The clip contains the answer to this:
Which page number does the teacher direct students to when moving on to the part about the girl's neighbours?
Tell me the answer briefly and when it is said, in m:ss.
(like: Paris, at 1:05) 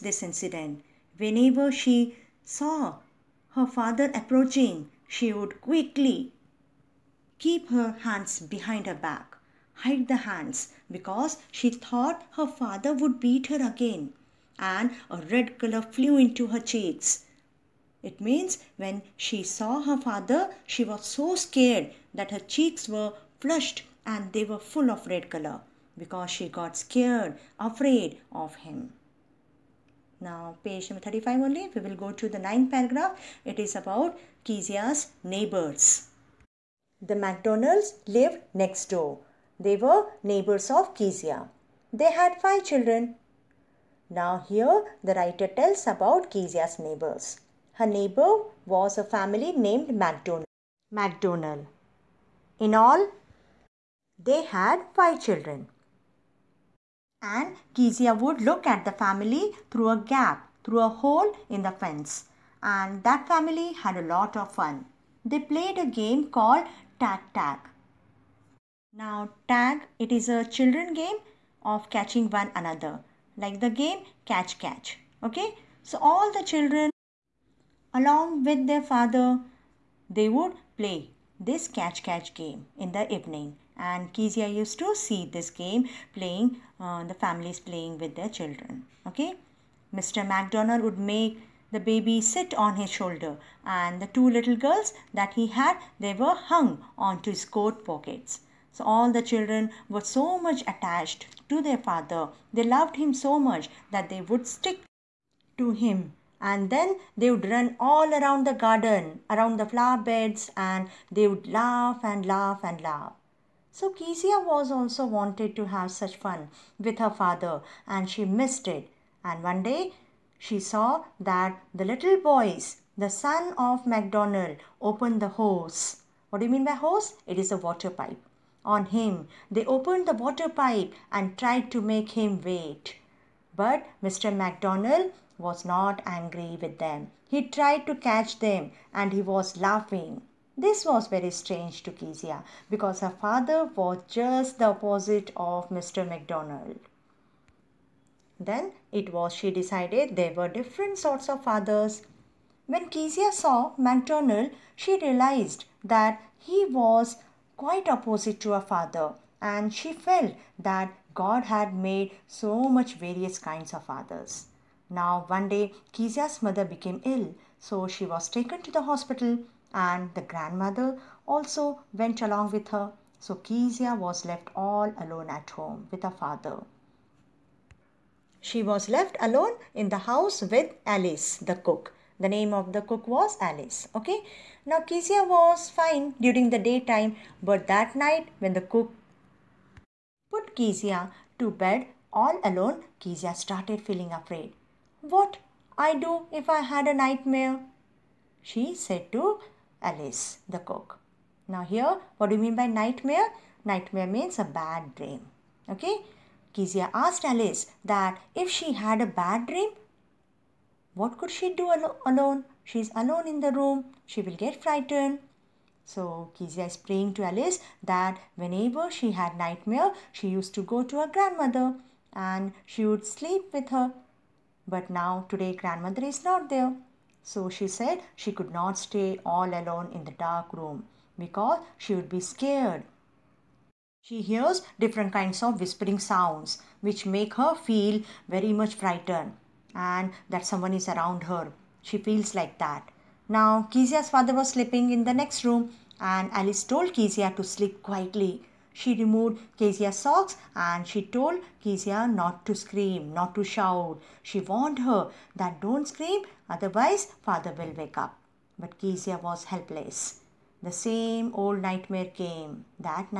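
35, at 0:31.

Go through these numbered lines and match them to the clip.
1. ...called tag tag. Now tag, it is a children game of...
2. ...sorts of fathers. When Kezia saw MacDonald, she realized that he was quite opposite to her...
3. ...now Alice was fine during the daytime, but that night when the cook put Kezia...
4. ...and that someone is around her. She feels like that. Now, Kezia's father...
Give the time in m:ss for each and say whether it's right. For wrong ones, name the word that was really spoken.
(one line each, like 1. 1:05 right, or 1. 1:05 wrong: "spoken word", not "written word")
1. 1:06 right
2. 2:30 right
3. 3:04 wrong: "Kezia", not "Alice"
4. 3:59 right.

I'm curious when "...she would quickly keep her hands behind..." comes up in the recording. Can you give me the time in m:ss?
0:05.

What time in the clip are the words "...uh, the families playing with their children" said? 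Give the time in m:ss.
1:26.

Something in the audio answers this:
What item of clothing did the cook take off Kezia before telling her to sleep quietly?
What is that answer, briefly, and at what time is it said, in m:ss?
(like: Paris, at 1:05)
socks, at 4:09.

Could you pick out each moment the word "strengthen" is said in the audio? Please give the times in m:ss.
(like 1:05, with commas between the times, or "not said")
not said.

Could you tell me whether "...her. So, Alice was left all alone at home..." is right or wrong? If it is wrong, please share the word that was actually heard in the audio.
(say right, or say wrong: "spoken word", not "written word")
wrong: "Kezia", not "Alice".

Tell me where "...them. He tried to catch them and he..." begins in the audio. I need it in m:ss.
2:16.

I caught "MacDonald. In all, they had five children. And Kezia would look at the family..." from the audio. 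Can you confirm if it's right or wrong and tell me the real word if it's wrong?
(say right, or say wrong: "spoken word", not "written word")
right.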